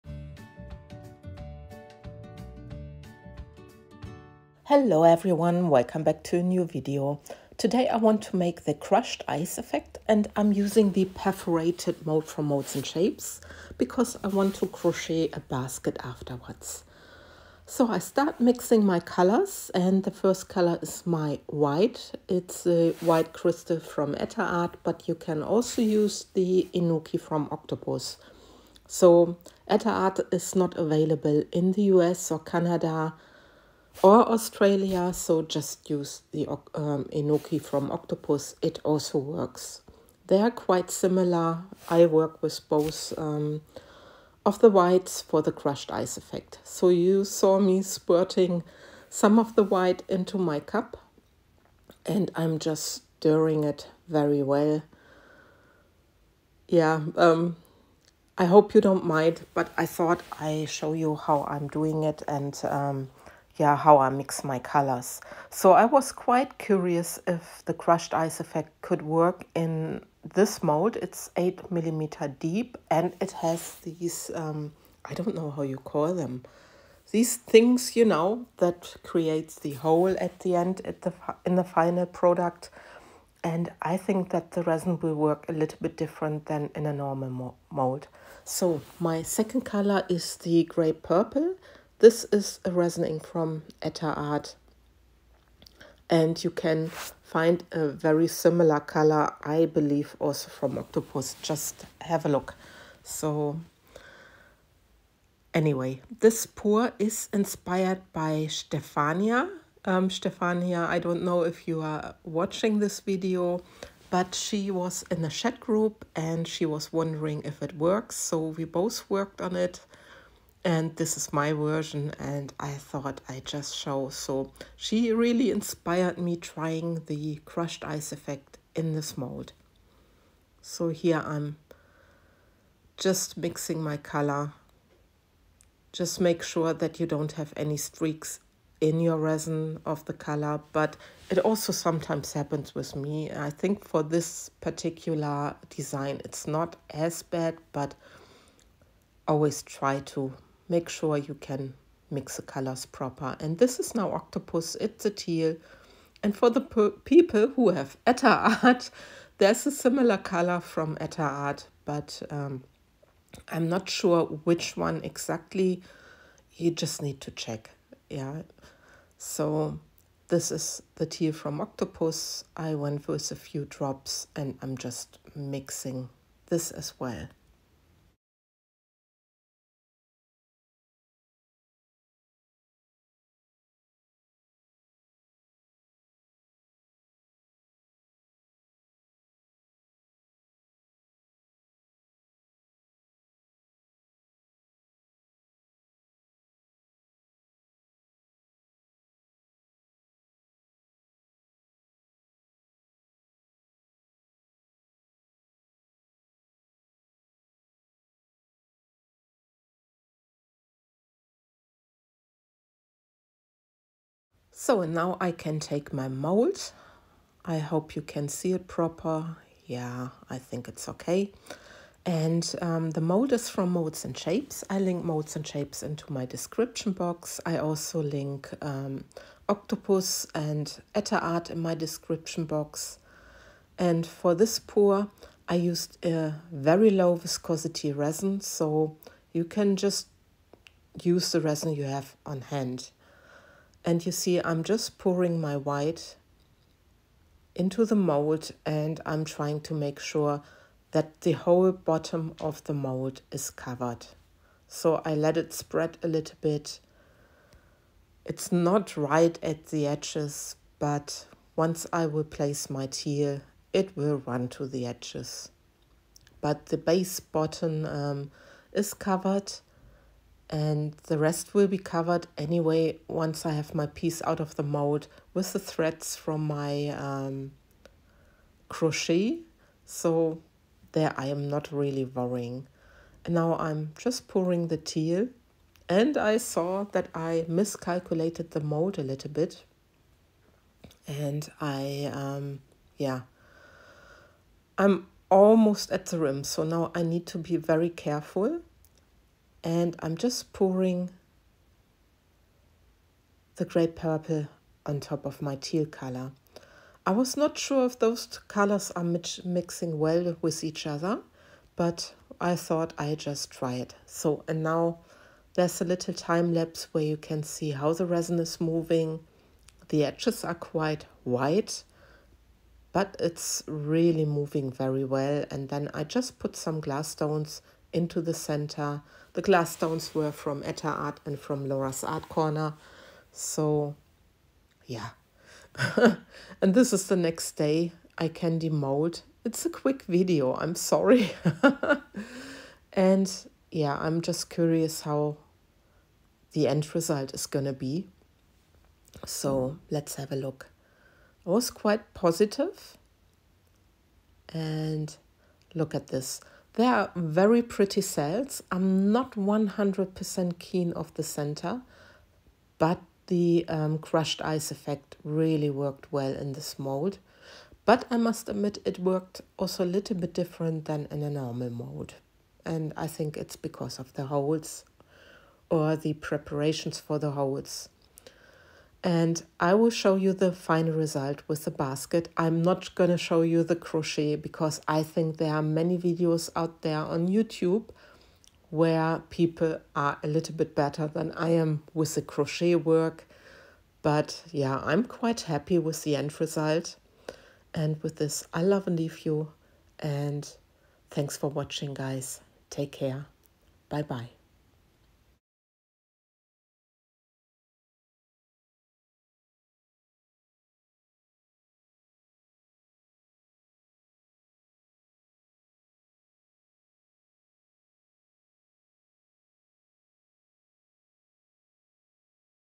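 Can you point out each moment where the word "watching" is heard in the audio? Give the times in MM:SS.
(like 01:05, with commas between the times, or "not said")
01:52, 06:41.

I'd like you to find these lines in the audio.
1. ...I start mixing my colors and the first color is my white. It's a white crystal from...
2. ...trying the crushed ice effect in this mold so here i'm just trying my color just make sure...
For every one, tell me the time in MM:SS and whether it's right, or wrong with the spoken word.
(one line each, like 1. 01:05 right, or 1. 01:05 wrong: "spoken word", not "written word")
1. 00:17 right
2. 02:06 wrong: "mixing", not "trying".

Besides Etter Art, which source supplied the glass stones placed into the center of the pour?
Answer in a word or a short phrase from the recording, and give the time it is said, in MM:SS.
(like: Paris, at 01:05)
Laura's Art Corner, at 05:31.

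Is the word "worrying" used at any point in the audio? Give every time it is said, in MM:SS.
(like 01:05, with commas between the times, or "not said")
04:42.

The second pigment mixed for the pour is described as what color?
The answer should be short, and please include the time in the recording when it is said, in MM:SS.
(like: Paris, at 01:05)
gray purple, at 01:30.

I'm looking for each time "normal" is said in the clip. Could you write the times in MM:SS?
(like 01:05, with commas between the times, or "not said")
01:26, 06:11.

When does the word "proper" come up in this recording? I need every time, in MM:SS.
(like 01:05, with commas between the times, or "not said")
02:32, 03:38.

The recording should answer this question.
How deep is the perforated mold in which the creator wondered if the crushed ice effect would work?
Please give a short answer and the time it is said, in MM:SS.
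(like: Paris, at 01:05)
8 millimeters, at 01:11.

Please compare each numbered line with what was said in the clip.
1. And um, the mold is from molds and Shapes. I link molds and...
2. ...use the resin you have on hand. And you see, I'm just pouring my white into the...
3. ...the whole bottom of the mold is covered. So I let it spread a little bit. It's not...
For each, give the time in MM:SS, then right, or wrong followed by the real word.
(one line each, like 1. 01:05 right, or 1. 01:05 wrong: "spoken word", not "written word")
1. 03:42 right
2. 04:01 right
3. 04:11 right.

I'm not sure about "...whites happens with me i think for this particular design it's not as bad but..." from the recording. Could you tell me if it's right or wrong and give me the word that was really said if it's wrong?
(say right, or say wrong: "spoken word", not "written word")
wrong: "sometimes", not "whites".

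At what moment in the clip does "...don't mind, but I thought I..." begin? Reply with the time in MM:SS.
00:58.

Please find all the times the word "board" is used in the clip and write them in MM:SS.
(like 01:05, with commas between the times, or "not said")
not said.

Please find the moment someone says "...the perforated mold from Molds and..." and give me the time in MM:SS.
00:10.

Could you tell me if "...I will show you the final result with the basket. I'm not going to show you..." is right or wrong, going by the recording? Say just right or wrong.
right.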